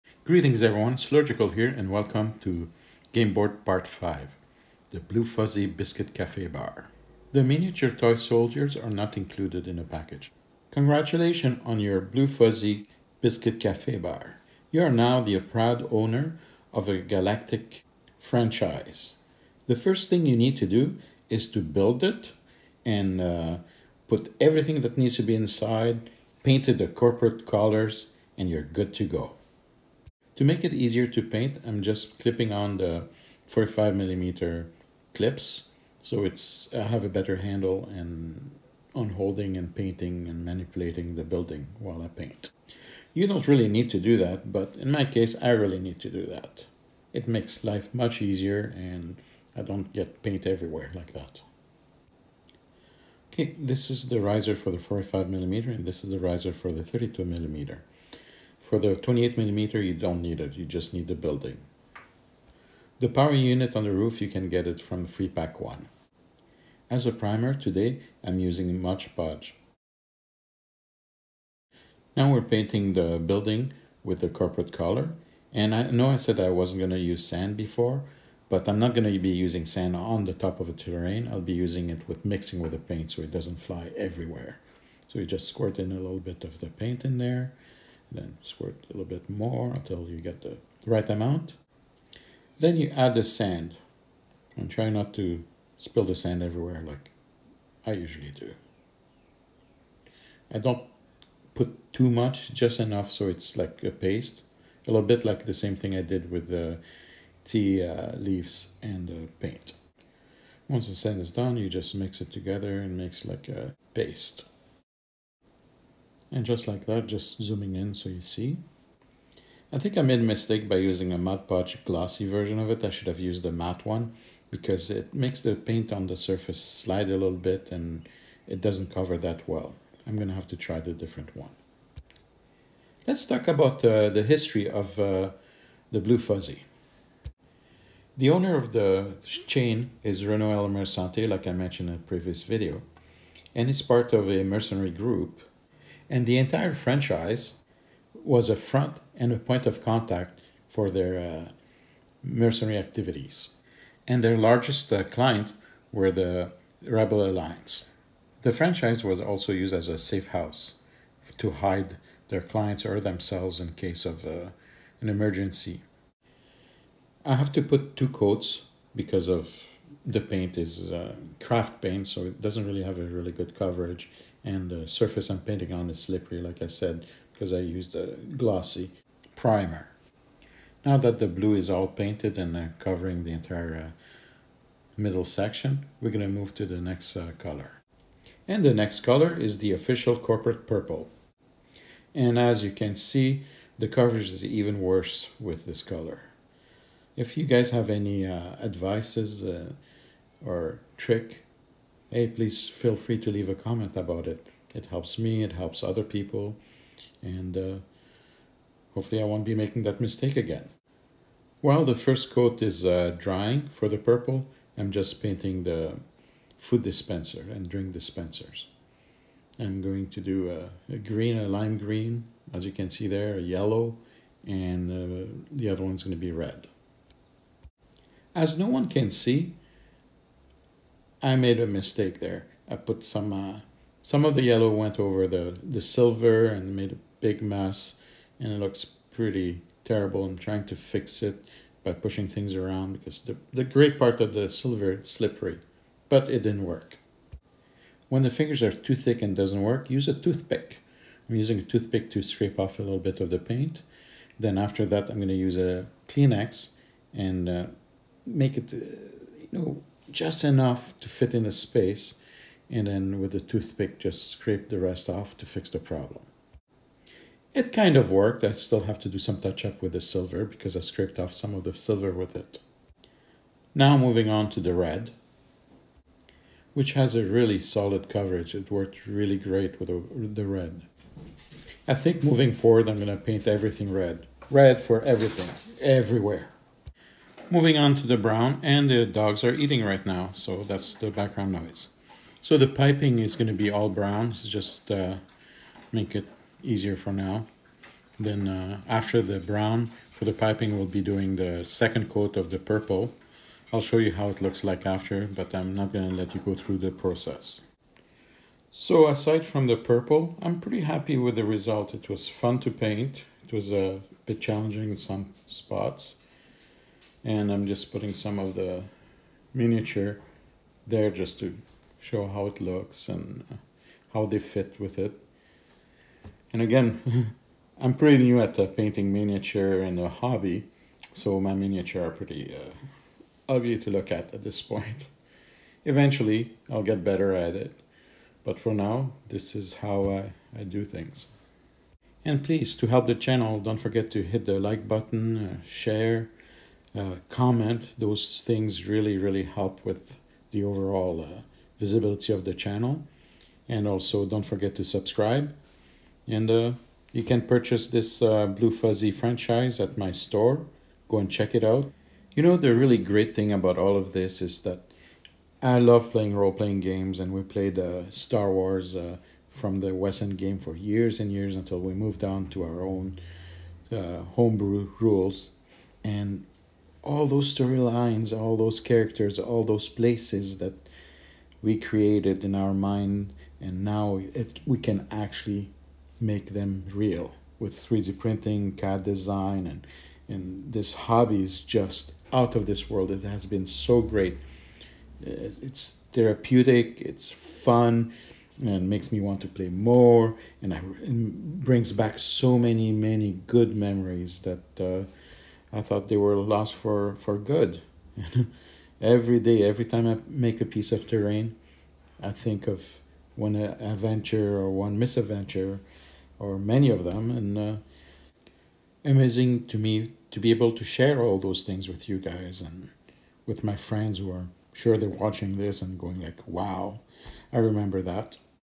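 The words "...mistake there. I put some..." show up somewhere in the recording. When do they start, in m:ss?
3:51.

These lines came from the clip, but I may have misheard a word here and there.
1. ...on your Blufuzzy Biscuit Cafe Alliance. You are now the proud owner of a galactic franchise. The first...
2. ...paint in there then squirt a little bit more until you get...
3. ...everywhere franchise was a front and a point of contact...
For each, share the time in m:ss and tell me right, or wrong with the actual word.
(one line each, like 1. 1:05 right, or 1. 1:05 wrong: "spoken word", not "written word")
1. 0:11 wrong: "Bar", not "Alliance"
2. 1:26 right
3. 2:26 wrong: "entire", not "everywhere".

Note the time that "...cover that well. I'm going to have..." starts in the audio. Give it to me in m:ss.
2:08.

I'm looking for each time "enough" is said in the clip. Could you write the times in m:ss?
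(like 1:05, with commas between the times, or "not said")
1:42, 4:20.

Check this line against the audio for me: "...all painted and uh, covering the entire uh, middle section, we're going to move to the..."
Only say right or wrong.
right.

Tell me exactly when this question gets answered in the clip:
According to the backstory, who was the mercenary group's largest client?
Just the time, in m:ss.
2:36.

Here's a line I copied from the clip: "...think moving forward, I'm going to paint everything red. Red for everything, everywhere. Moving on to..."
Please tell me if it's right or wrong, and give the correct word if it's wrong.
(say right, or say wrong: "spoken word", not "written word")
right.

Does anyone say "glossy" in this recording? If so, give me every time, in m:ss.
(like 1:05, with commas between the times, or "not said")
2:01, 2:58.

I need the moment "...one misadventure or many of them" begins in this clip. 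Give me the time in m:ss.
6:54.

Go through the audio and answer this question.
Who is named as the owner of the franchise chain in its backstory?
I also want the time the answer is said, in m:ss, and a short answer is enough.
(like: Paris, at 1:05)
Renault Elmer Santé, at 2:20.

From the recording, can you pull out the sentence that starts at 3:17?
If you guys have any uh, advices uh, or trick hey, please feel free to leave a comment about it.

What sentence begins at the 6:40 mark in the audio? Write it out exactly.
And I, it brings back so many many good memories that.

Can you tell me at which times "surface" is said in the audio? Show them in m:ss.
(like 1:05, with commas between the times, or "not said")
2:06, 2:54.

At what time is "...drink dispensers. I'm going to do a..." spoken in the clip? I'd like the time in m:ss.
3:37.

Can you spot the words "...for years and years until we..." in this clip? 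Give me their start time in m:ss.
6:10.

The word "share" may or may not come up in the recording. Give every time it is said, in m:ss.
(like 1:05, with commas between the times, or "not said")
5:45, 7:00.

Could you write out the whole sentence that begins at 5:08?
So aside from the purple, I'm pretty happy with the result.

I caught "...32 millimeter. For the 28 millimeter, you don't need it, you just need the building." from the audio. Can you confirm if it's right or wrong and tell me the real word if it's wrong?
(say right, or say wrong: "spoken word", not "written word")
right.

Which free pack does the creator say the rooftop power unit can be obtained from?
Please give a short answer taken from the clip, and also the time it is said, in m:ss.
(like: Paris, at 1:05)
Free pack 1, at 1:05.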